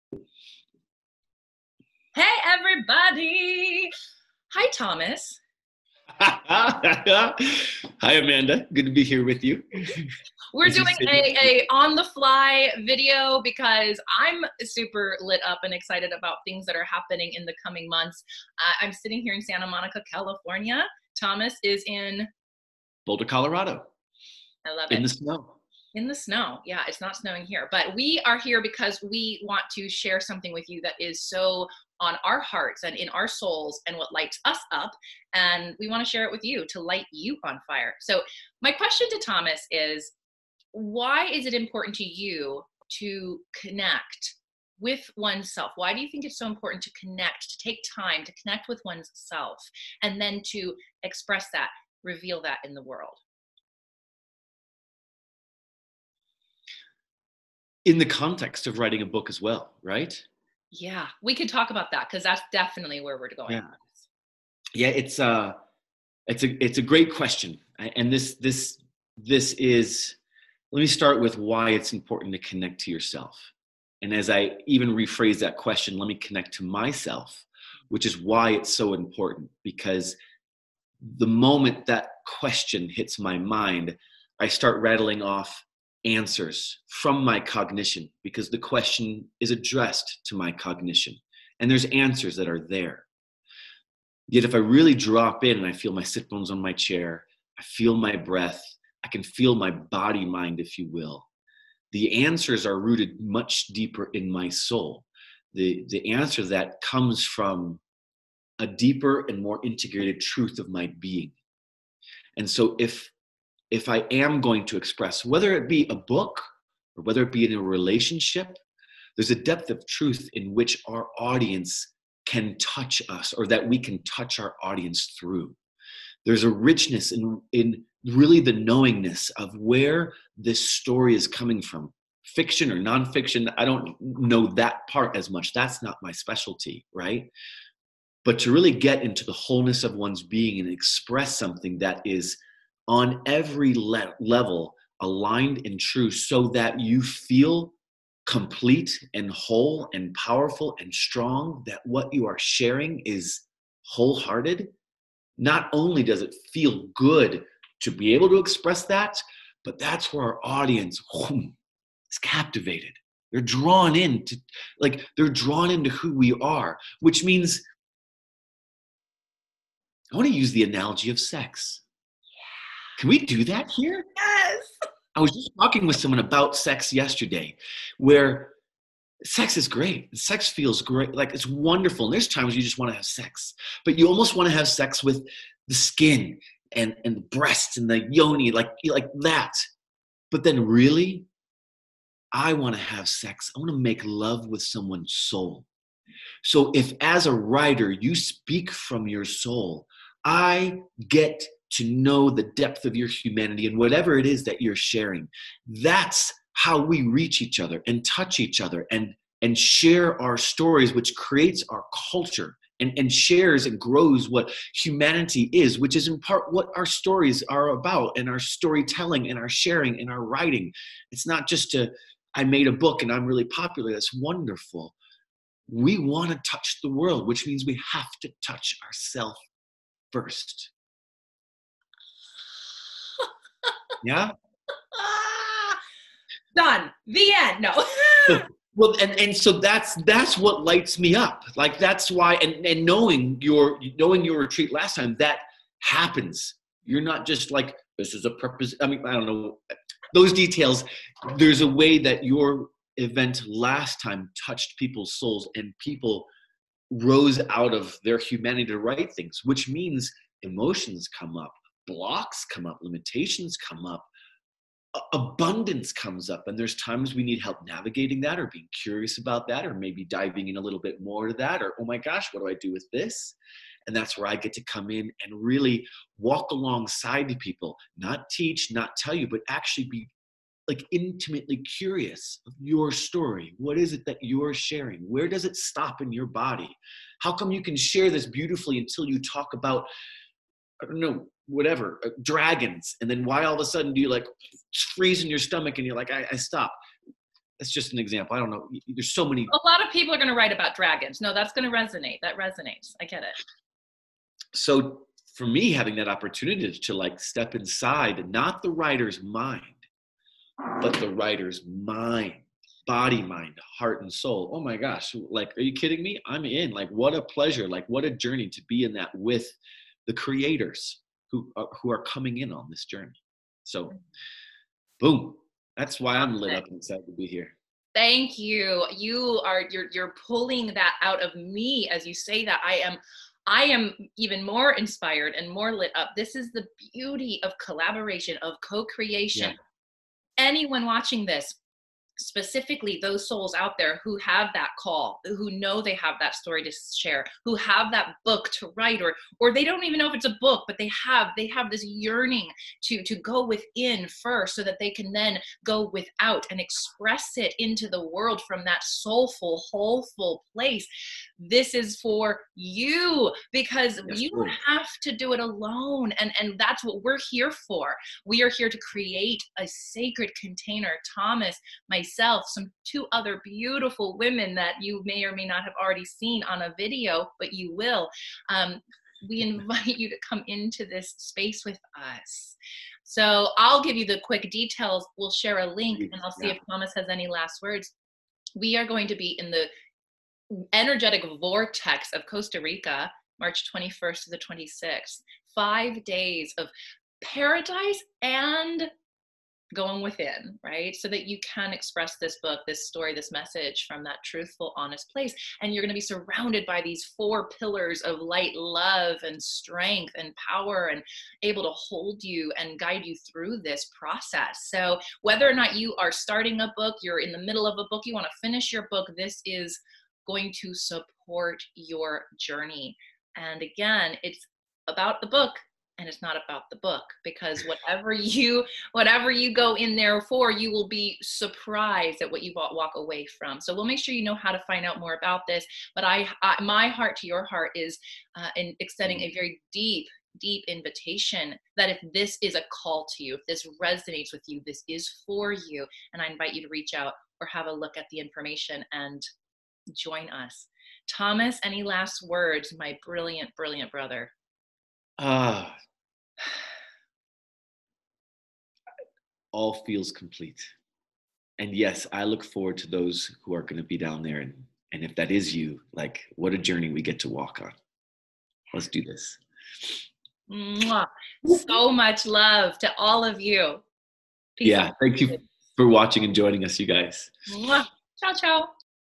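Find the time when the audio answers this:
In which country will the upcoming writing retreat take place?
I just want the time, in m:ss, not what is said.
6:32.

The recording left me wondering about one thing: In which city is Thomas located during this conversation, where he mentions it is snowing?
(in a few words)
Boulder, Colorado.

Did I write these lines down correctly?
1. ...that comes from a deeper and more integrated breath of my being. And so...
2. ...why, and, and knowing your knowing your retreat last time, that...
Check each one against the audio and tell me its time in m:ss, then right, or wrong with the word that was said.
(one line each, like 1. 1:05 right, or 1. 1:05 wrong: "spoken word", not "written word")
1. 1:46 wrong: "truth", not "breath"
2. 4:02 right.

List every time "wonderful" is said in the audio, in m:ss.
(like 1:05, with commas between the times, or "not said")
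3:01, 3:44.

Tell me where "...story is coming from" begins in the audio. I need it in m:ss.
2:10.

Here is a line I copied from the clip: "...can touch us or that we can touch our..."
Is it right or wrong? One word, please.
right.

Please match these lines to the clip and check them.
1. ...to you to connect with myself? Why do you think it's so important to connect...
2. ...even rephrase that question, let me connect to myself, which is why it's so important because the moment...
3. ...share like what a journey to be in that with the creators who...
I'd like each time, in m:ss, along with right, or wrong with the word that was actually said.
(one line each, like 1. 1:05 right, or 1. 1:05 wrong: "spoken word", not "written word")
1. 0:41 wrong: "oneself", not "myself"
2. 1:14 right
3. 5:17 wrong: "pleasure", not "share".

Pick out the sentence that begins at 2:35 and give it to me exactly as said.
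Not only does it feel good to be able to express that, but that's where our audience whoom, is captivated.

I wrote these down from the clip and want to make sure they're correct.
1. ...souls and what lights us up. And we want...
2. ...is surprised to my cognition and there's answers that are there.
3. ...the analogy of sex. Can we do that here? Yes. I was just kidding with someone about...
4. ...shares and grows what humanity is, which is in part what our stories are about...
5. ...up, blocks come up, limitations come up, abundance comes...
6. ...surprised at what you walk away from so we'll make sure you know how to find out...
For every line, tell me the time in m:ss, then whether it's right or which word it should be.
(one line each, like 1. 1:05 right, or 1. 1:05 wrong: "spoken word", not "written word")
1. 0:33 right
2. 1:29 wrong: "addressed", not "surprised"
3. 2:50 wrong: "talking", not "kidding"
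4. 3:33 right
5. 4:21 right
6. 7:11 right.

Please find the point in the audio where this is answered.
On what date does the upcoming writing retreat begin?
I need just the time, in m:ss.
6:33.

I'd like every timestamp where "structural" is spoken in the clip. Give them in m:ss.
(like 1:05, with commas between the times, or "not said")
not said.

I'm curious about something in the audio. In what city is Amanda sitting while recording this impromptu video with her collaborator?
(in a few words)
Santa Monica, California.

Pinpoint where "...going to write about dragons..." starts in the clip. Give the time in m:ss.
5:00.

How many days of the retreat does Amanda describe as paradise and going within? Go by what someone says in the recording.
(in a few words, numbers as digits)
5.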